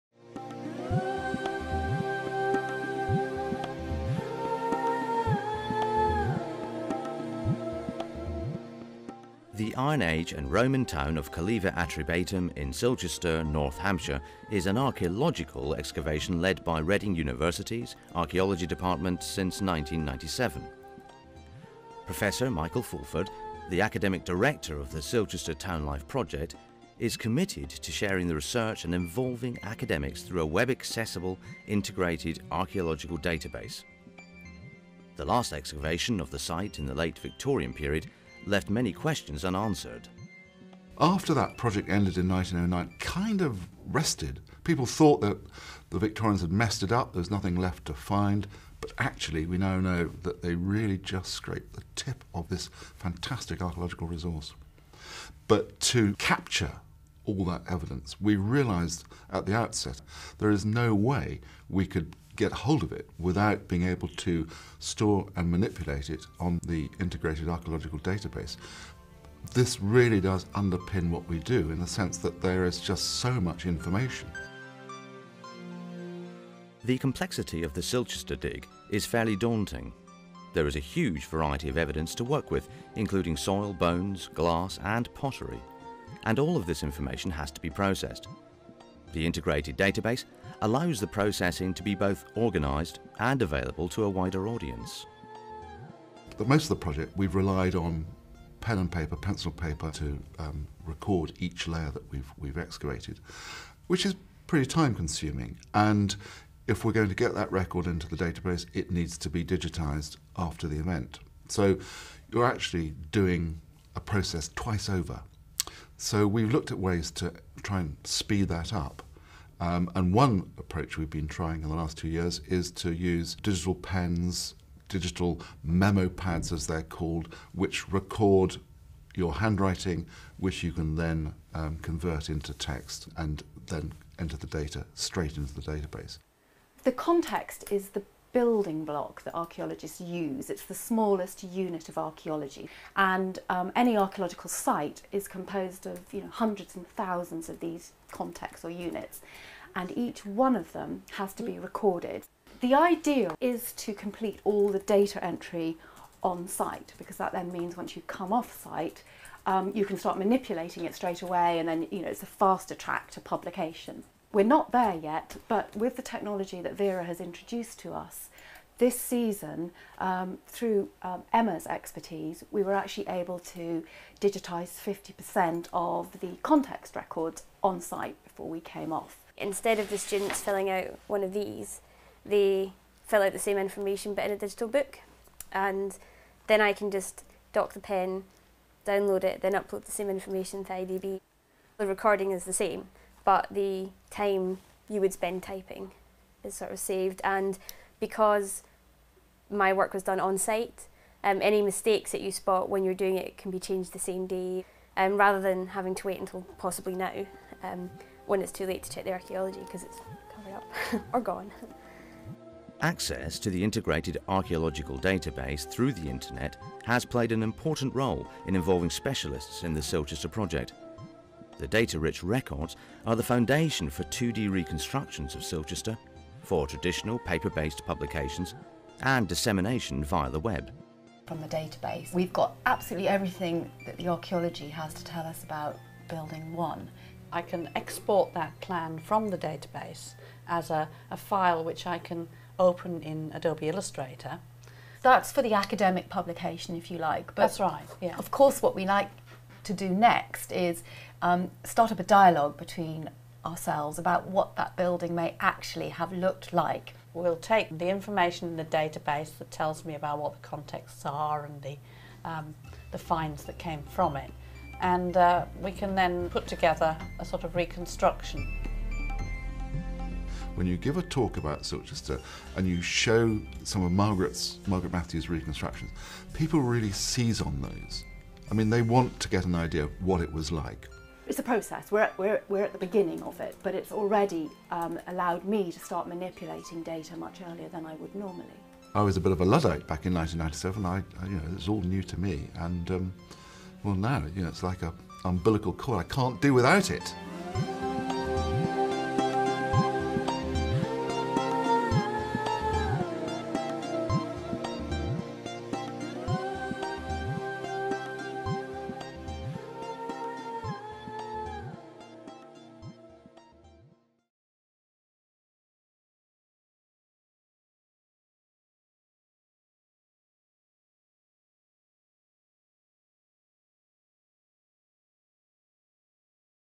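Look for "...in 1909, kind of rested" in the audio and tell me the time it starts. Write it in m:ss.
0:42.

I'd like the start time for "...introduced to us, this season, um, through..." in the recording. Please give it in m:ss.
2:47.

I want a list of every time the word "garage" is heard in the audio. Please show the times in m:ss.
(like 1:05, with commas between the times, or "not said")
not said.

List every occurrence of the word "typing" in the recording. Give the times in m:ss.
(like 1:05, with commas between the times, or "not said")
3:15.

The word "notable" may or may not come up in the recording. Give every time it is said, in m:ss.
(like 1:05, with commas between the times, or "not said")
not said.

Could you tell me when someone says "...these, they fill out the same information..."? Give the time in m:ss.
3:01.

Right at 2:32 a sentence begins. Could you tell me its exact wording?
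The ideal is to complete all the data entry on site because that then means once you come off site.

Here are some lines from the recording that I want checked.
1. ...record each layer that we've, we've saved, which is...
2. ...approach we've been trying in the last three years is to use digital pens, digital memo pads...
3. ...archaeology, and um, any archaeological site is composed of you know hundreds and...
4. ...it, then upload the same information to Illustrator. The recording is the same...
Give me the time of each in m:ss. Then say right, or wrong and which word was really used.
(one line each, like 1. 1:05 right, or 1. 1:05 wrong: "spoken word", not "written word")
1. 1:40 wrong: "excavated", not "saved"
2. 2:00 wrong: "two", not "three"
3. 2:21 right
4. 3:09 wrong: "IDB", not "Illustrator".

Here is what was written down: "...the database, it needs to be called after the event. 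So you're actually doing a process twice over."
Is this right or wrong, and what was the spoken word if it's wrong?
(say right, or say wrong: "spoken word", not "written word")
wrong: "digitised", not "called".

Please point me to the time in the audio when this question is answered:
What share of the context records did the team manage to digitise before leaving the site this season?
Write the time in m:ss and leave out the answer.
2:54.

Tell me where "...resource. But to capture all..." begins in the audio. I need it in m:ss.
0:54.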